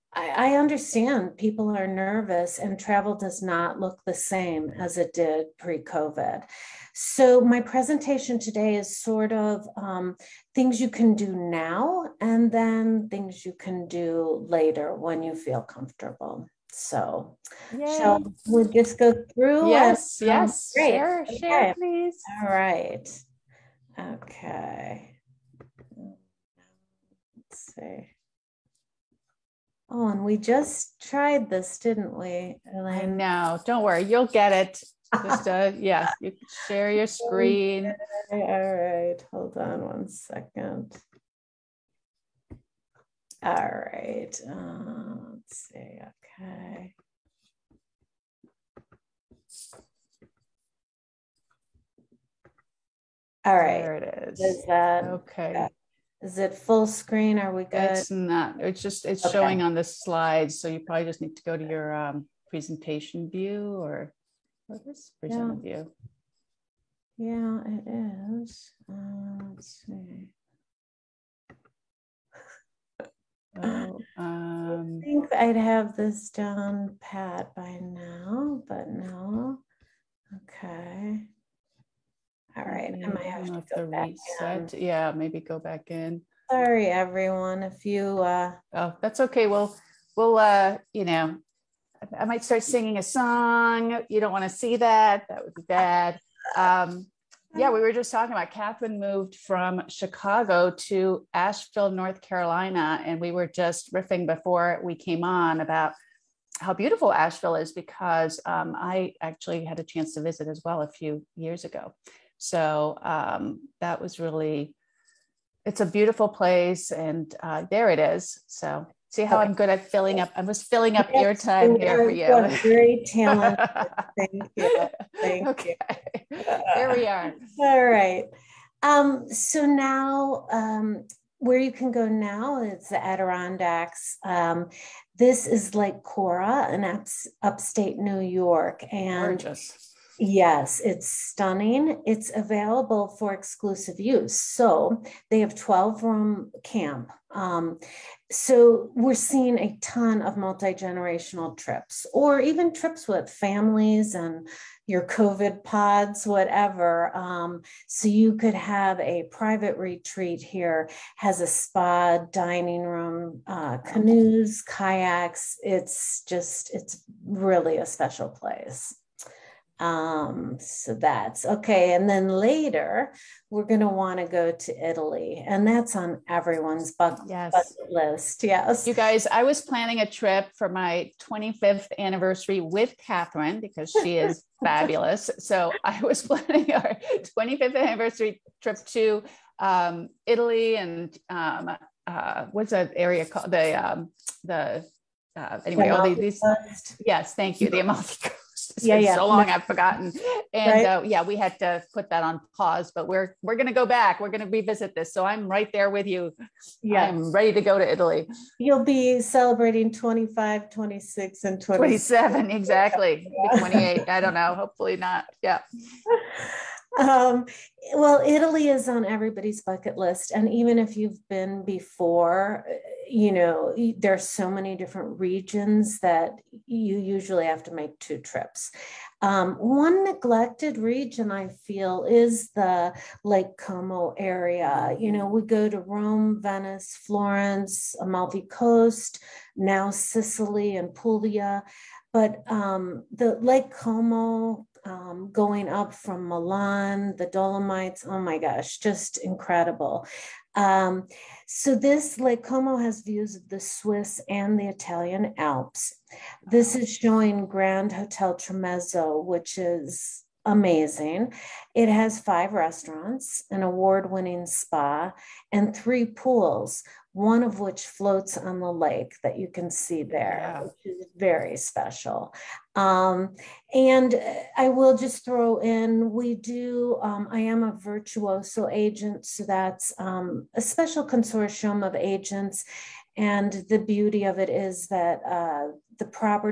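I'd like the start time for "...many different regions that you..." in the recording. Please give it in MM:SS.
03:44.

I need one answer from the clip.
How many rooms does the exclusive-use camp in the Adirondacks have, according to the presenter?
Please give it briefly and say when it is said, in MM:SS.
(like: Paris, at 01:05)
12, at 02:25.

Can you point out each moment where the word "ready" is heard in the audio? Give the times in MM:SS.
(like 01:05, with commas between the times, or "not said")
03:27.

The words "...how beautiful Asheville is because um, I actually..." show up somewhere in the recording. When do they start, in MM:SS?
01:46.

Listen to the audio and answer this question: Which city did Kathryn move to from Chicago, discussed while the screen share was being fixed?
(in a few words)
Asheville, North Carolina.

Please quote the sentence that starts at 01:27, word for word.
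If you uh oh, that's okay.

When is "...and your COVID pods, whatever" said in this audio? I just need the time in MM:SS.
02:34.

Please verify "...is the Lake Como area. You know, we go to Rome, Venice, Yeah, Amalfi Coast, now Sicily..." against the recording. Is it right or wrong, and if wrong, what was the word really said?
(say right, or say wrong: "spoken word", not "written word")
wrong: "Florence", not "Yeah".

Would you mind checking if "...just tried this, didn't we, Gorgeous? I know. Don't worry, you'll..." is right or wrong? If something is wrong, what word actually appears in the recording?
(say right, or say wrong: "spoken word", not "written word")
wrong: "Hélène", not "Gorgeous".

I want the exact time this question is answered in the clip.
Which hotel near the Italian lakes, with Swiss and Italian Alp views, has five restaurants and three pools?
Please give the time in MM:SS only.
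04:17.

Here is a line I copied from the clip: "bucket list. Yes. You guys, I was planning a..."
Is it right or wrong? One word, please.
right.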